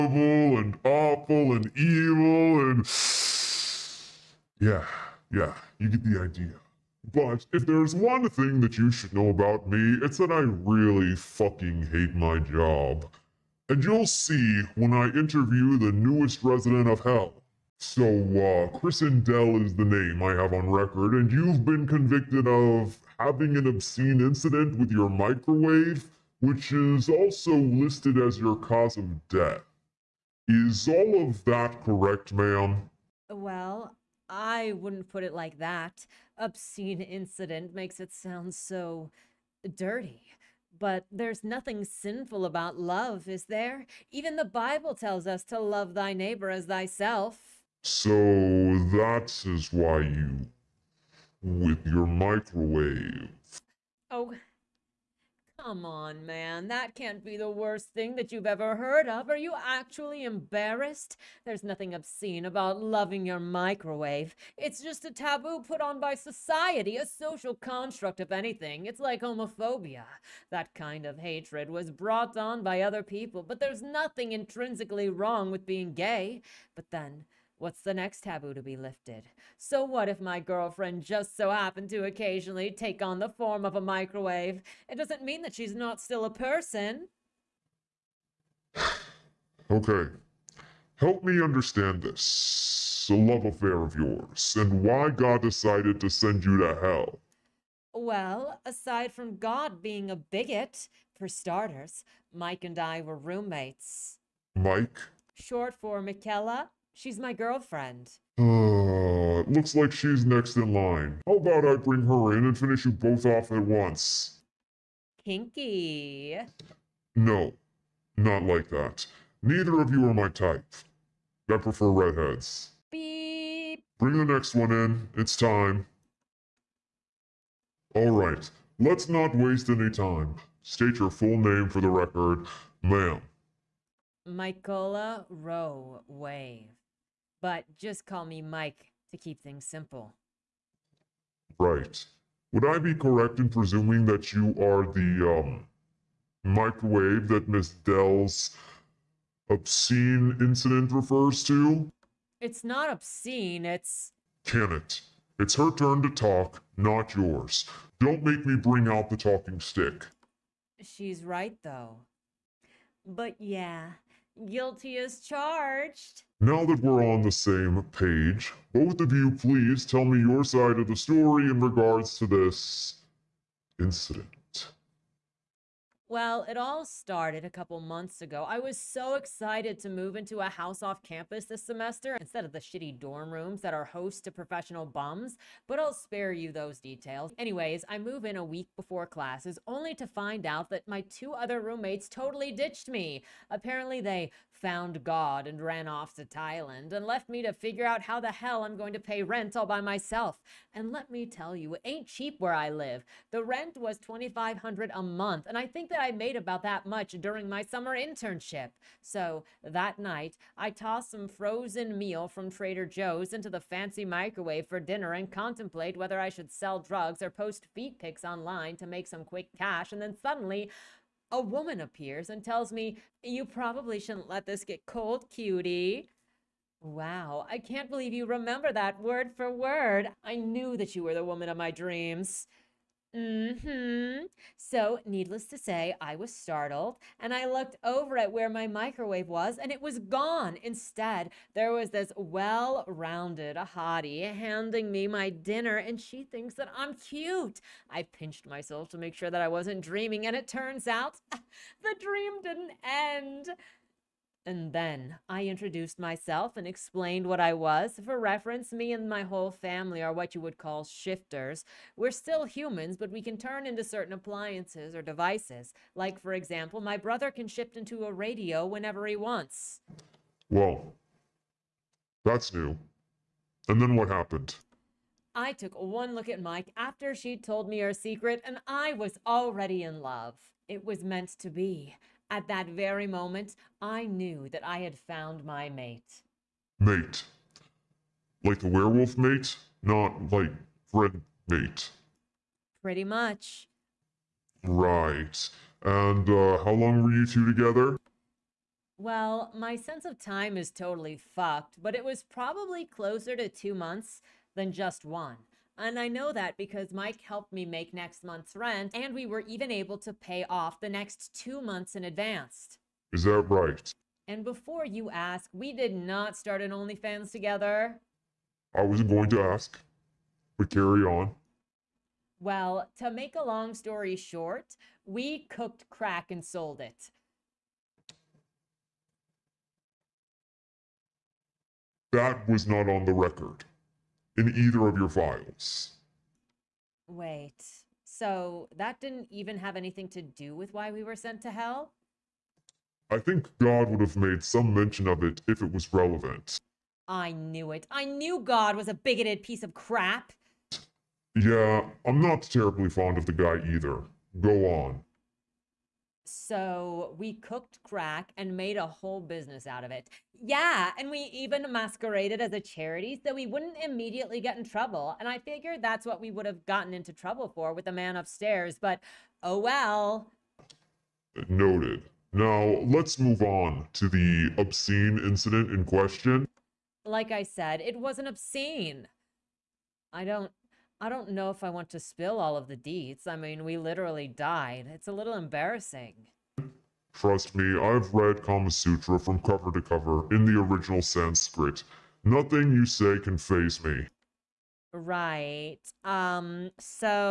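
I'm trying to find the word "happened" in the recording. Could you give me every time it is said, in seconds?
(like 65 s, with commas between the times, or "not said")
81 s, 274 s.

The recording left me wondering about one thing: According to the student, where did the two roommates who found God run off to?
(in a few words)
Thailand.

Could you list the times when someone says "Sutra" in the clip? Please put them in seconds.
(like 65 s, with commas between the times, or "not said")
388 s.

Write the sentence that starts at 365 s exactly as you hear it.
And I figured that's what we would have gotten into trouble for with the man upstairs, but oh well.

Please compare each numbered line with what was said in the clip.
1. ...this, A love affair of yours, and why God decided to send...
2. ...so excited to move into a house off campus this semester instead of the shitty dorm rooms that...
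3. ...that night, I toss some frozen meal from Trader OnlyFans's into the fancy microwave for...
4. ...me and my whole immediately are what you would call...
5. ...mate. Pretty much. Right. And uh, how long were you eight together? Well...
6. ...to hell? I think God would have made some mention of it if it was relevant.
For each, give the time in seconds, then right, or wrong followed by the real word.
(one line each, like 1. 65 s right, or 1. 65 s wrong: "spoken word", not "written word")
1. 92 s right
2. 178 s right
3. 209 s wrong: "Joe", not "OnlyFans"
4. 258 s wrong: "family", not "immediately"
5. 291 s wrong: "two", not "eight"
6. 341 s right.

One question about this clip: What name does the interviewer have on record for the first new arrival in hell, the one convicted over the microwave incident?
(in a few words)
Chris Dell.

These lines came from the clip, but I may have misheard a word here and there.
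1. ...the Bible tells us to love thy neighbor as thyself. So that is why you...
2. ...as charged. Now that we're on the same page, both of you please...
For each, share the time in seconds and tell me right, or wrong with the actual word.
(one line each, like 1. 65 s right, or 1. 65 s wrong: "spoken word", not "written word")
1. 44 s right
2. 164 s right.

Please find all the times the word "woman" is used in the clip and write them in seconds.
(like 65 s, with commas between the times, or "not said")
221 s, 231 s.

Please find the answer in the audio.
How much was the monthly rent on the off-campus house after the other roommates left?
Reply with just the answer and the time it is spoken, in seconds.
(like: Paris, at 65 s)
2500, at 203 s.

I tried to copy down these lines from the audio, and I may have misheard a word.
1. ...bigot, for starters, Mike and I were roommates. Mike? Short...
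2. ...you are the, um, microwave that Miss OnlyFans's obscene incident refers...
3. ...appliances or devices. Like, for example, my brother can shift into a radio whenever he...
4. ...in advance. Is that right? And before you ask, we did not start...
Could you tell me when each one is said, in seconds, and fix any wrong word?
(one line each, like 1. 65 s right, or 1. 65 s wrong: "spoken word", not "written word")
1. 100 s right
2. 144 s wrong: "Dell", not "OnlyFans"
3. 264 s right
4. 311 s right.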